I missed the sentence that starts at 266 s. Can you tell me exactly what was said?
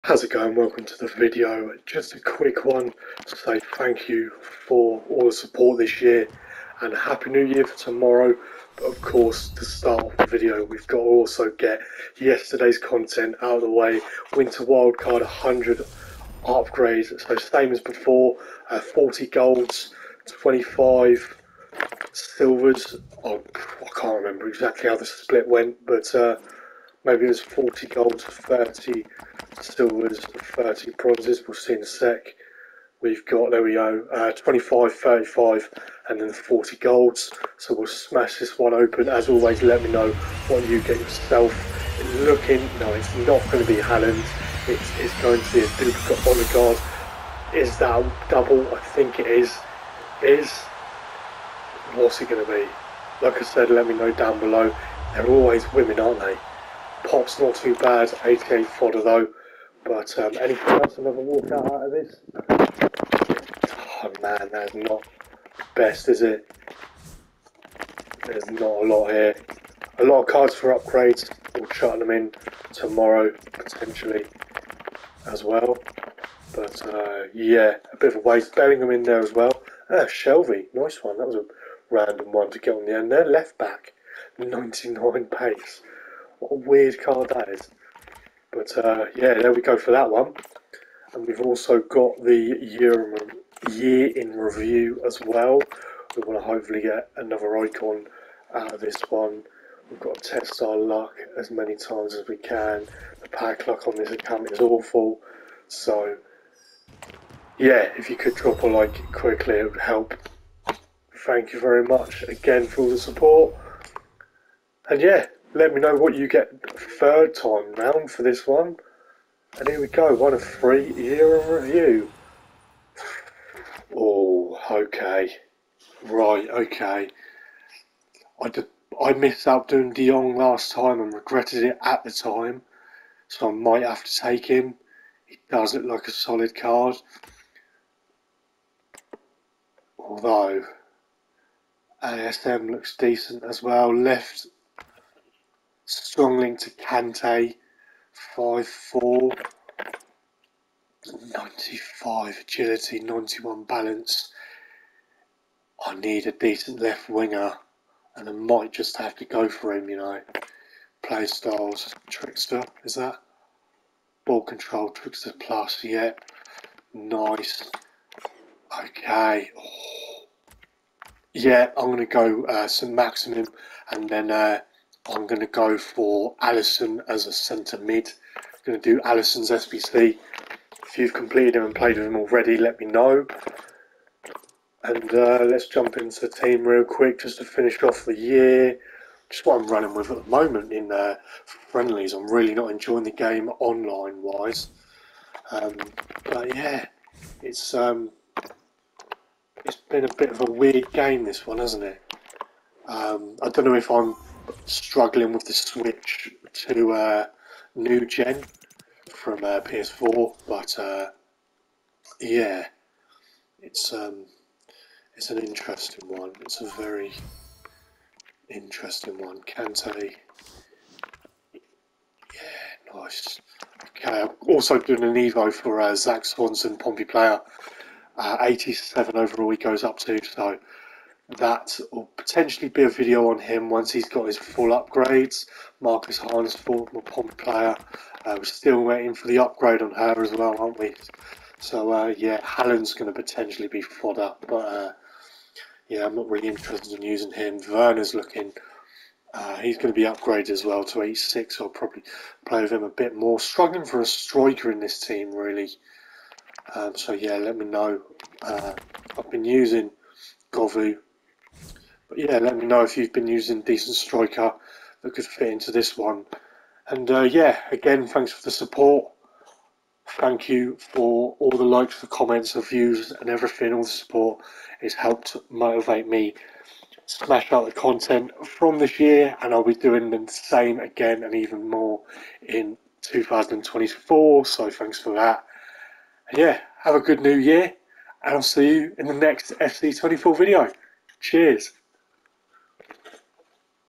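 And uh, yeah, again, thanks for the support.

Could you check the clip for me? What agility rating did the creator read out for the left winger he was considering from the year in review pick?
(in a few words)
95.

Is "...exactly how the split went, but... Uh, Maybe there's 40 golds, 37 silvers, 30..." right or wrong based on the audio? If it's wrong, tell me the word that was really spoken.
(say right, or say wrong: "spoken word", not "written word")
wrong: "30", not "37".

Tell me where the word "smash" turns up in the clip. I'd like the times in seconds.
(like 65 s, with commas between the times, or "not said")
37 s, 277 s.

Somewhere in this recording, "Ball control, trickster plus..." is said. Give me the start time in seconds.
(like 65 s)
164 s.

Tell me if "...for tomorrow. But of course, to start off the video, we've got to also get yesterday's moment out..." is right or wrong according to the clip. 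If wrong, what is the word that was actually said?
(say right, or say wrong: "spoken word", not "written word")
wrong: "content", not "moment".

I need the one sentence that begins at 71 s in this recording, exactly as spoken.
We'll chart them in tomorrow, potentially, as well.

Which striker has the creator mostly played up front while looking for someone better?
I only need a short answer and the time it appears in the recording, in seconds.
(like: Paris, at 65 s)
Govu, at 260 s.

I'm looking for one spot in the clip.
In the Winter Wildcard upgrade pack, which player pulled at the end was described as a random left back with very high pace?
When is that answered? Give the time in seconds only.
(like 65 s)
80 s.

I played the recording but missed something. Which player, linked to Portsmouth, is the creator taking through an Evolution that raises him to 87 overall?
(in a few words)
Zak Swanson.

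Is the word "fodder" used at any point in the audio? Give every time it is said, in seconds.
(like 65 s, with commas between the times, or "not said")
58 s, 243 s.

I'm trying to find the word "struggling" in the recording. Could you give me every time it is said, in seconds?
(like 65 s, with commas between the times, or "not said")
204 s, 253 s.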